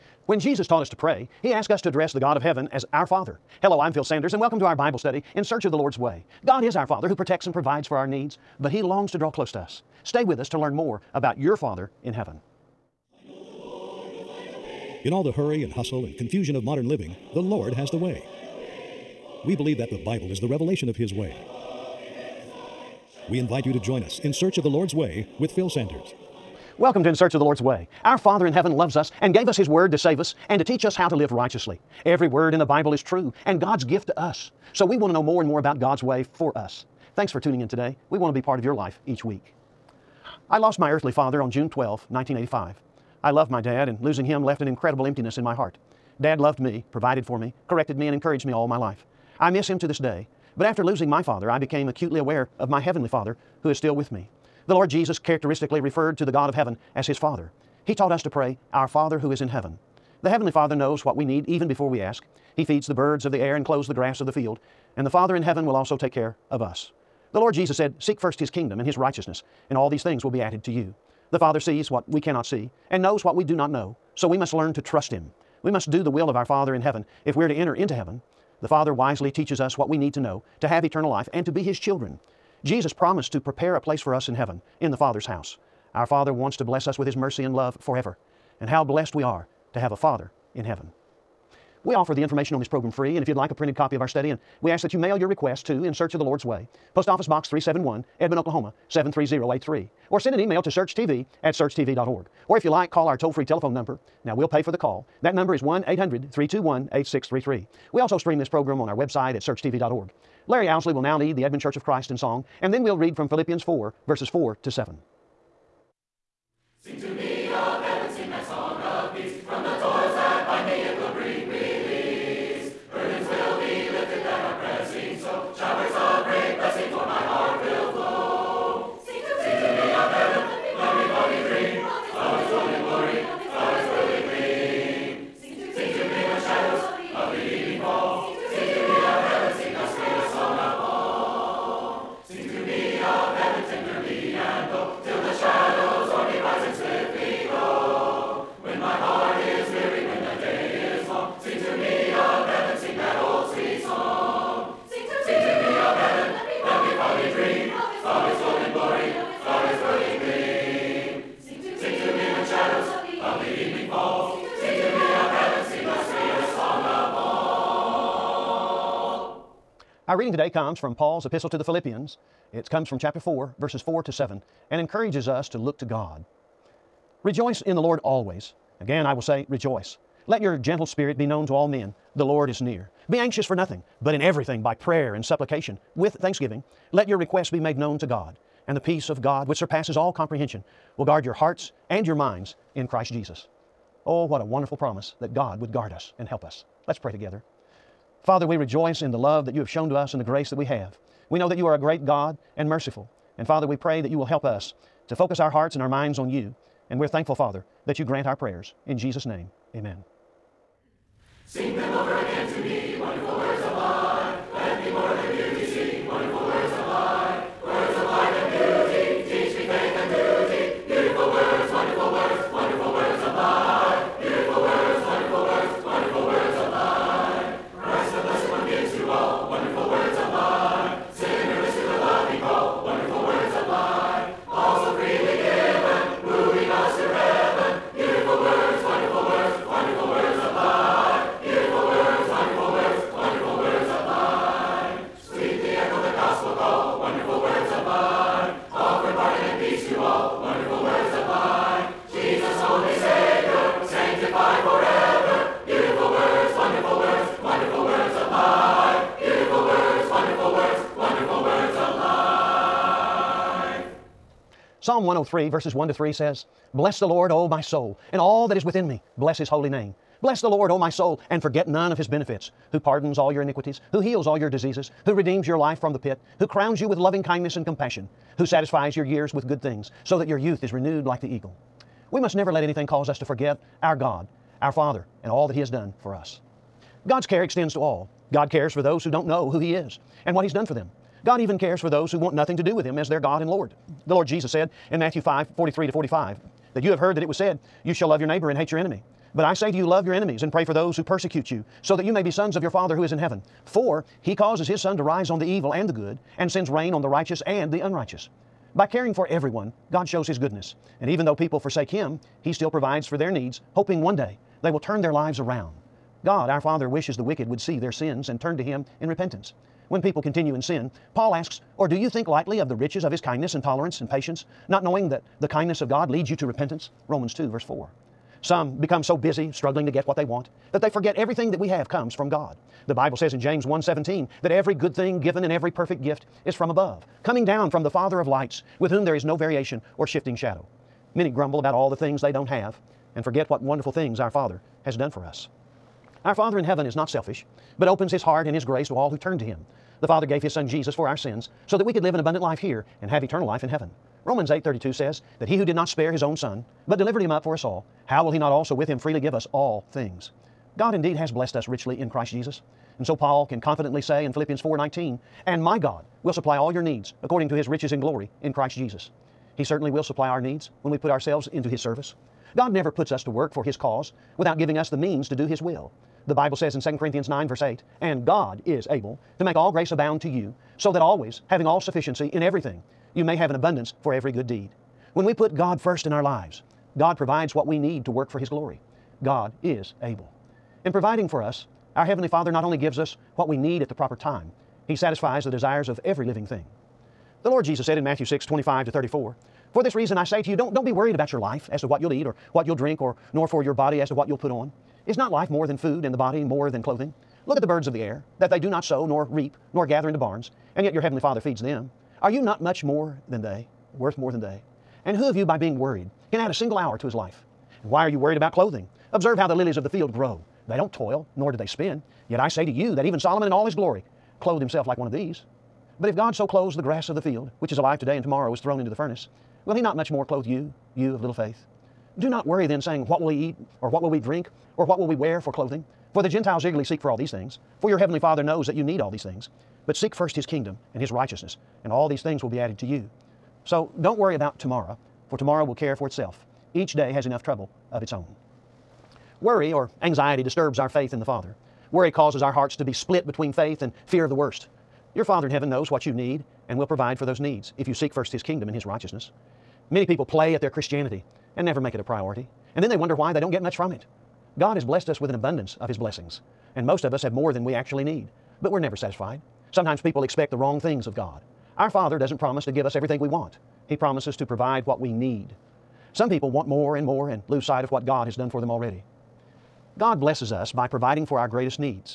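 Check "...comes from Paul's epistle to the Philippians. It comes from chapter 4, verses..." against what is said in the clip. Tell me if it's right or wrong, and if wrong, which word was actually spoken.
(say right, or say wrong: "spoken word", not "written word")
right.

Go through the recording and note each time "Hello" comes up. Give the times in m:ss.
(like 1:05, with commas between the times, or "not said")
0:03.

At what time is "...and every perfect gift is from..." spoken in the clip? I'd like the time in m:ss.
5:35.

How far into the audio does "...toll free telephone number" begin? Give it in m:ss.
1:43.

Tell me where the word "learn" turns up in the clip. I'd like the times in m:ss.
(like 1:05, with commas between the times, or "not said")
0:10, 1:14.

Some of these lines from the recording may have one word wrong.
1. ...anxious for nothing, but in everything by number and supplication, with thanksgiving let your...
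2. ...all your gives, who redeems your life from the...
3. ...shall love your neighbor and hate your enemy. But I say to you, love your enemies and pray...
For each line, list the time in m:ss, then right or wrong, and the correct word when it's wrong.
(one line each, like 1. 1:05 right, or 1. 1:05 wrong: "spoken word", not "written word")
1. 3:03 wrong: "prayer", not "number"
2. 4:34 wrong: "diseases", not "gives"
3. 4:57 right.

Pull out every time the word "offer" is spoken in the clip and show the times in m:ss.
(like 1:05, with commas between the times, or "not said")
1:31.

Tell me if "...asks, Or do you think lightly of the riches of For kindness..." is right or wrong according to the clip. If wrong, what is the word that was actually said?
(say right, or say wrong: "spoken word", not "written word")
wrong: "His", not "For".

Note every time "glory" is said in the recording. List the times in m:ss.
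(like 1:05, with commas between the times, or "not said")
6:08, 6:28, 7:03.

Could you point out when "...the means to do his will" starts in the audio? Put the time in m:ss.
6:14.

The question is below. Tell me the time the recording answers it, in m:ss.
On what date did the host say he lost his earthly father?
0:41.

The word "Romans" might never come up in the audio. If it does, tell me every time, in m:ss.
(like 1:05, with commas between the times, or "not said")
5:27, 5:54.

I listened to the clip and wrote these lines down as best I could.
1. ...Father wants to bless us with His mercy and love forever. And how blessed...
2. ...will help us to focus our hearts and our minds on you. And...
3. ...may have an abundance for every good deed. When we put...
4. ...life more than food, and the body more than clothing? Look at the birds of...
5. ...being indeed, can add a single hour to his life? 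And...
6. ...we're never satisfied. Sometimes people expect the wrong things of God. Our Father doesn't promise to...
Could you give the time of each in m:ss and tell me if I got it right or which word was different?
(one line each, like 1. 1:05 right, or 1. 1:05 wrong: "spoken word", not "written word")
1. 1:26 right
2. 3:24 right
3. 6:23 right
4. 6:45 right
5. 6:55 wrong: "worried", not "indeed"
6. 7:48 right.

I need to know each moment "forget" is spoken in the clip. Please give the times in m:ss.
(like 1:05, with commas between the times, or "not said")
4:31, 4:43, 5:30, 5:43.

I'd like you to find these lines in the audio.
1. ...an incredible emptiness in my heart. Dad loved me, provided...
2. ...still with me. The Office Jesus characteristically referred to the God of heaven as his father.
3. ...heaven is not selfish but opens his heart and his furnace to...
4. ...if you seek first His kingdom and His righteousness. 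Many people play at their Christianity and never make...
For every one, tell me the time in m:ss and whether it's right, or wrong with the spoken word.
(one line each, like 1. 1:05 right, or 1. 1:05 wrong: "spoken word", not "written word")
1. 0:44 right
2. 0:53 wrong: "Lord", not "Office"
3. 5:46 wrong: "grace", not "furnace"
4. 7:37 right.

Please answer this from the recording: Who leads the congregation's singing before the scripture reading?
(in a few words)
Larry Owsley.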